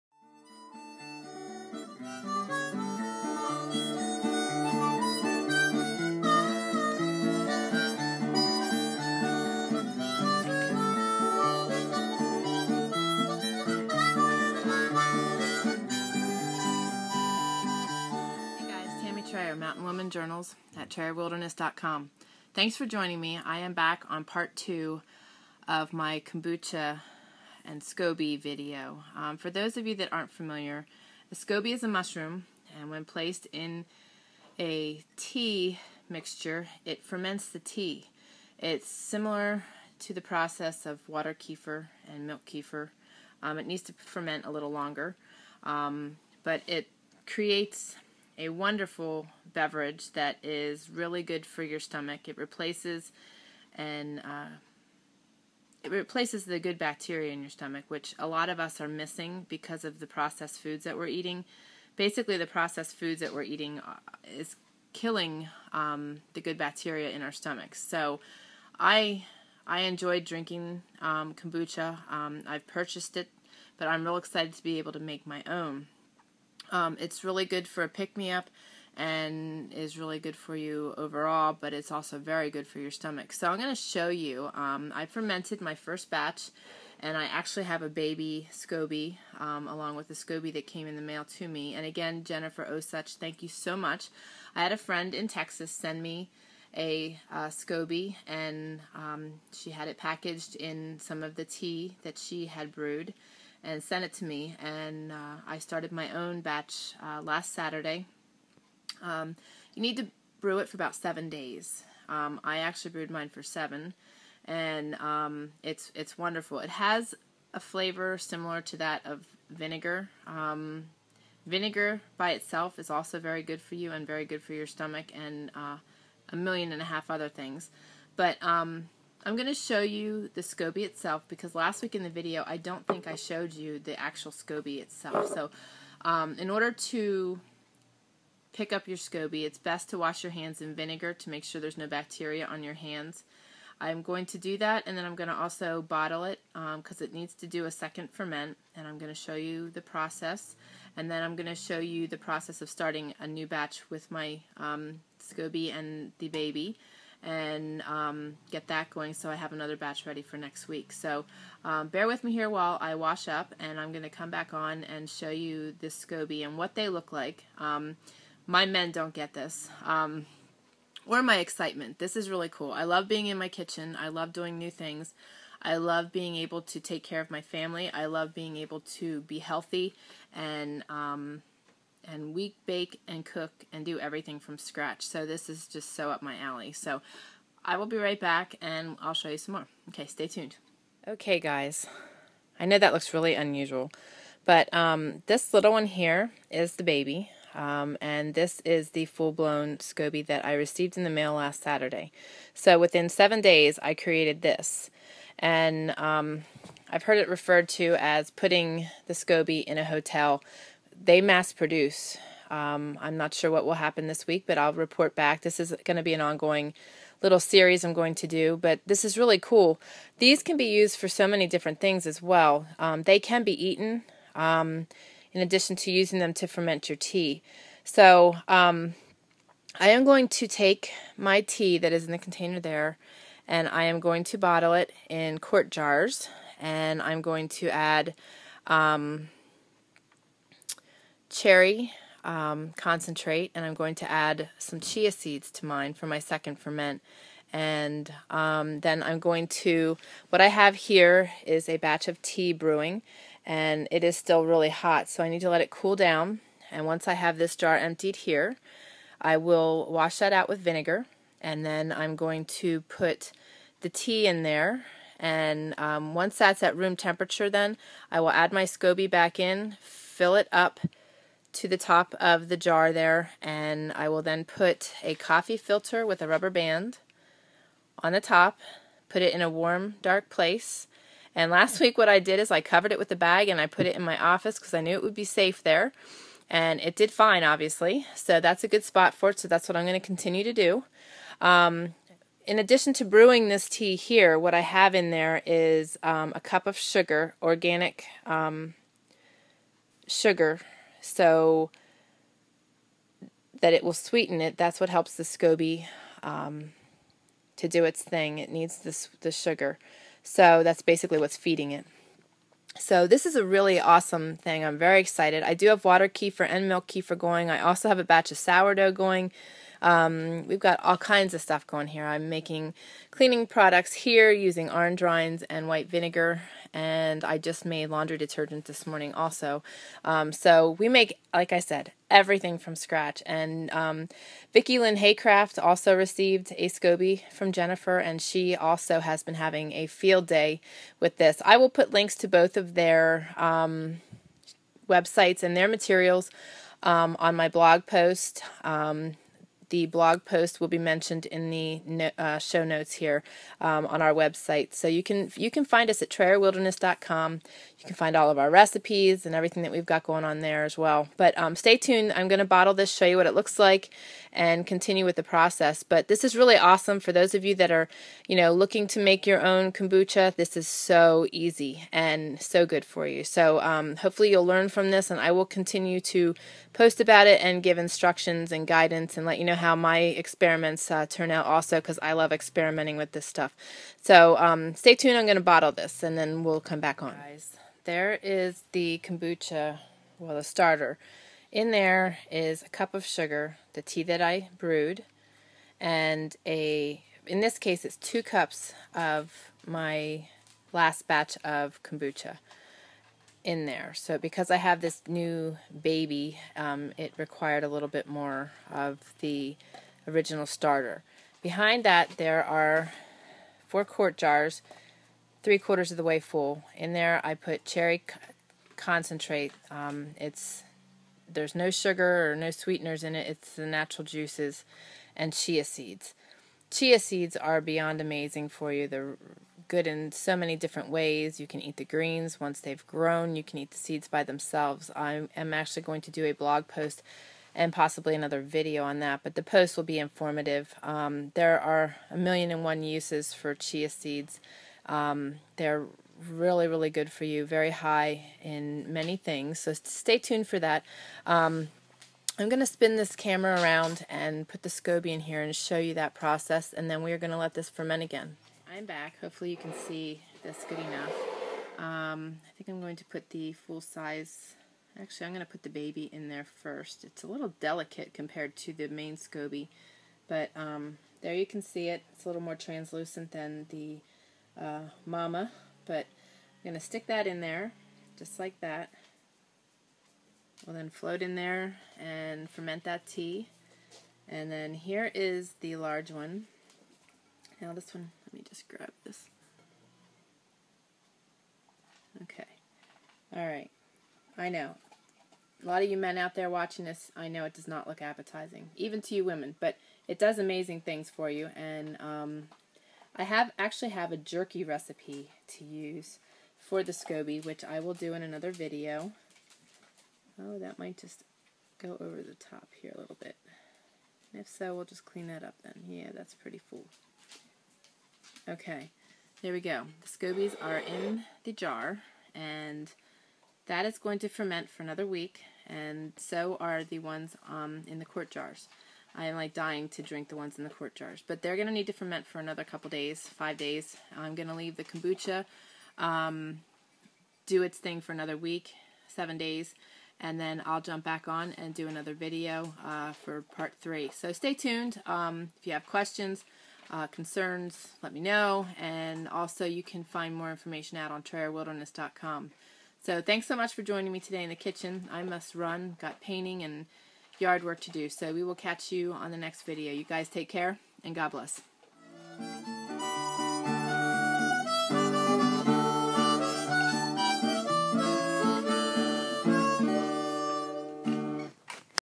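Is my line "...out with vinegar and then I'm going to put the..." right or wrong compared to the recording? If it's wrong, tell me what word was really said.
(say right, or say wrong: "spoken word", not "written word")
right.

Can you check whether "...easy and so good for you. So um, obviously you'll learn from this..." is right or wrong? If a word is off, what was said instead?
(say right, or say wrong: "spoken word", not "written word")
wrong: "hopefully", not "obviously".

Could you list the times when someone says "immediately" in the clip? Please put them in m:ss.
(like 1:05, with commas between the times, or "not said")
not said.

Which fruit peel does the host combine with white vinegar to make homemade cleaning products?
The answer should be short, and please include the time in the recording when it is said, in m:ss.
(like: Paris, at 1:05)
orange rinds, at 5:24.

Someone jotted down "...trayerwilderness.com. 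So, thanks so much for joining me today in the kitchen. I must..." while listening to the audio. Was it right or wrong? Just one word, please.
right.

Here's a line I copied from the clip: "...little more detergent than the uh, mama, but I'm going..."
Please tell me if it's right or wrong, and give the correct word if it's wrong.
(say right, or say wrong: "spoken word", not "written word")
wrong: "translucent", not "detergent".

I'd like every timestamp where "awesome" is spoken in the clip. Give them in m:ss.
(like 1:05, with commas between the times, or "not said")
5:13, 6:06.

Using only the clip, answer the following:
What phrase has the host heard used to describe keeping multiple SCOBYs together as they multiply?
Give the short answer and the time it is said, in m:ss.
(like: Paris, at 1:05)
putting the SCOBY in a hotel, at 3:28.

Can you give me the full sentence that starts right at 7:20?
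Um, there are a million and one uses for chia seeds.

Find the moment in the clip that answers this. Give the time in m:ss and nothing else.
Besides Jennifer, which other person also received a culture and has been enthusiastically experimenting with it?
5:34.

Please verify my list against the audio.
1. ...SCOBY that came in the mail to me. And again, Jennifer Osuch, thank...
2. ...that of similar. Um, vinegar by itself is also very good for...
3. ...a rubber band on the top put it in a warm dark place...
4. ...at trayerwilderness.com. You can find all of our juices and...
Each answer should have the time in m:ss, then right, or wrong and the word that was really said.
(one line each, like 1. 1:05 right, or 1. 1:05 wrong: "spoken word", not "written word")
1. 1:30 right
2. 1:58 wrong: "vinegar", not "similar"
3. 4:36 right
4. 5:56 wrong: "recipes", not "juices".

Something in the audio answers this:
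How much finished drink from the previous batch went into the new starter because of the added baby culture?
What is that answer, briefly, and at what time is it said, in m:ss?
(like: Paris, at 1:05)
2 cups, at 6:37.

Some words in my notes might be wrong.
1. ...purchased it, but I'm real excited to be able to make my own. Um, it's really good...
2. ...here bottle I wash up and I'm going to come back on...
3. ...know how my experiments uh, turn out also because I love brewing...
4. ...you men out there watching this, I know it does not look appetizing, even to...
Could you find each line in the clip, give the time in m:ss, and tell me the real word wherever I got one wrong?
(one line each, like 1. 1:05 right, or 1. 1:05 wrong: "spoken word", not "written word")
1. 1:12 right
2. 2:42 wrong: "while", not "bottle"
3. 6:19 wrong: "experimenting", not "brewing"
4. 8:15 right.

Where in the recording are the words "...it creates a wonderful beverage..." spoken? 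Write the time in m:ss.
0:46.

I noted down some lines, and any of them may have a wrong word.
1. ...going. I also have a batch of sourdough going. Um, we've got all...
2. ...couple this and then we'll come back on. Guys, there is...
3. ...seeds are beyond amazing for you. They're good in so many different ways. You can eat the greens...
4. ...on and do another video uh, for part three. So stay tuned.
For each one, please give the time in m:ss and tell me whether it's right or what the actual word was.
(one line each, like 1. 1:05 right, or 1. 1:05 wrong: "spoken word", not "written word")
1. 5:17 right
2. 6:25 wrong: "bottle", not "couple"
3. 7:06 right
4. 9:01 right.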